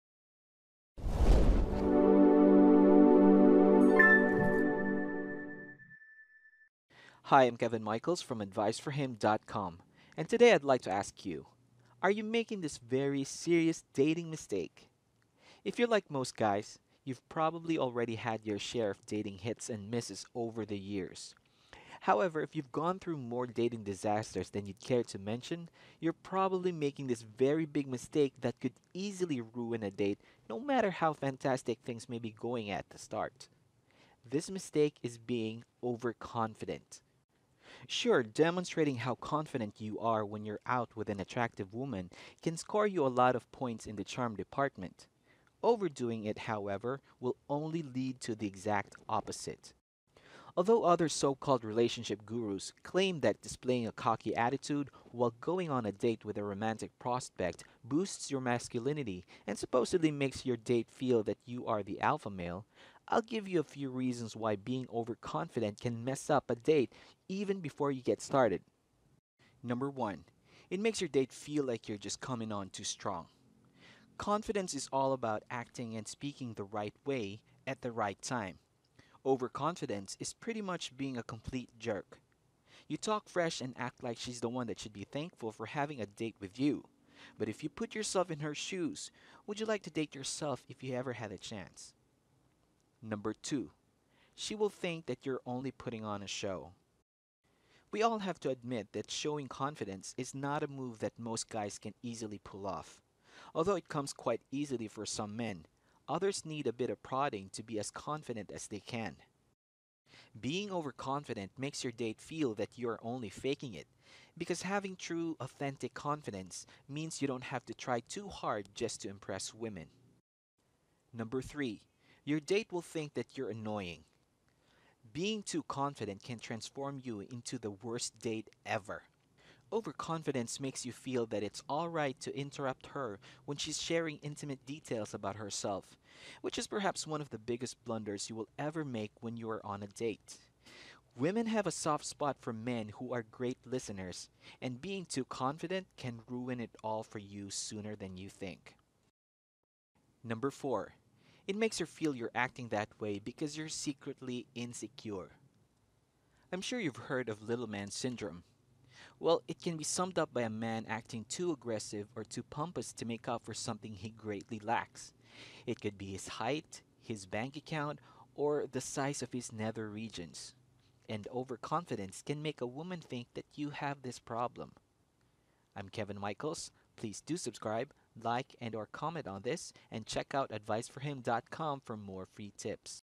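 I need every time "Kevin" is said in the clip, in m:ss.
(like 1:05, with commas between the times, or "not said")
0:07, 2:55.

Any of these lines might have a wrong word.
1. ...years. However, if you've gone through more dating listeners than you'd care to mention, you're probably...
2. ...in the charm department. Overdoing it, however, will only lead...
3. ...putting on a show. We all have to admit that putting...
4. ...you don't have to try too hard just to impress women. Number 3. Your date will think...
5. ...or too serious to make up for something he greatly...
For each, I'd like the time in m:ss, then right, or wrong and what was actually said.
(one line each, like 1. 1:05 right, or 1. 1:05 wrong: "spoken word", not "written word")
1. 0:20 wrong: "disasters", not "listeners"
2. 0:43 right
3. 1:35 wrong: "showing", not "putting"
4. 1:57 right
5. 2:42 wrong: "pompous", not "serious".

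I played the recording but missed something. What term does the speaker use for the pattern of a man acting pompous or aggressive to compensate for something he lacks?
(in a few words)
Little man syndrome.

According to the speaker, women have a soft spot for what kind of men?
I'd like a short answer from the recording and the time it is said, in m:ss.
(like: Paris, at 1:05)
Great listeners, at 2:23.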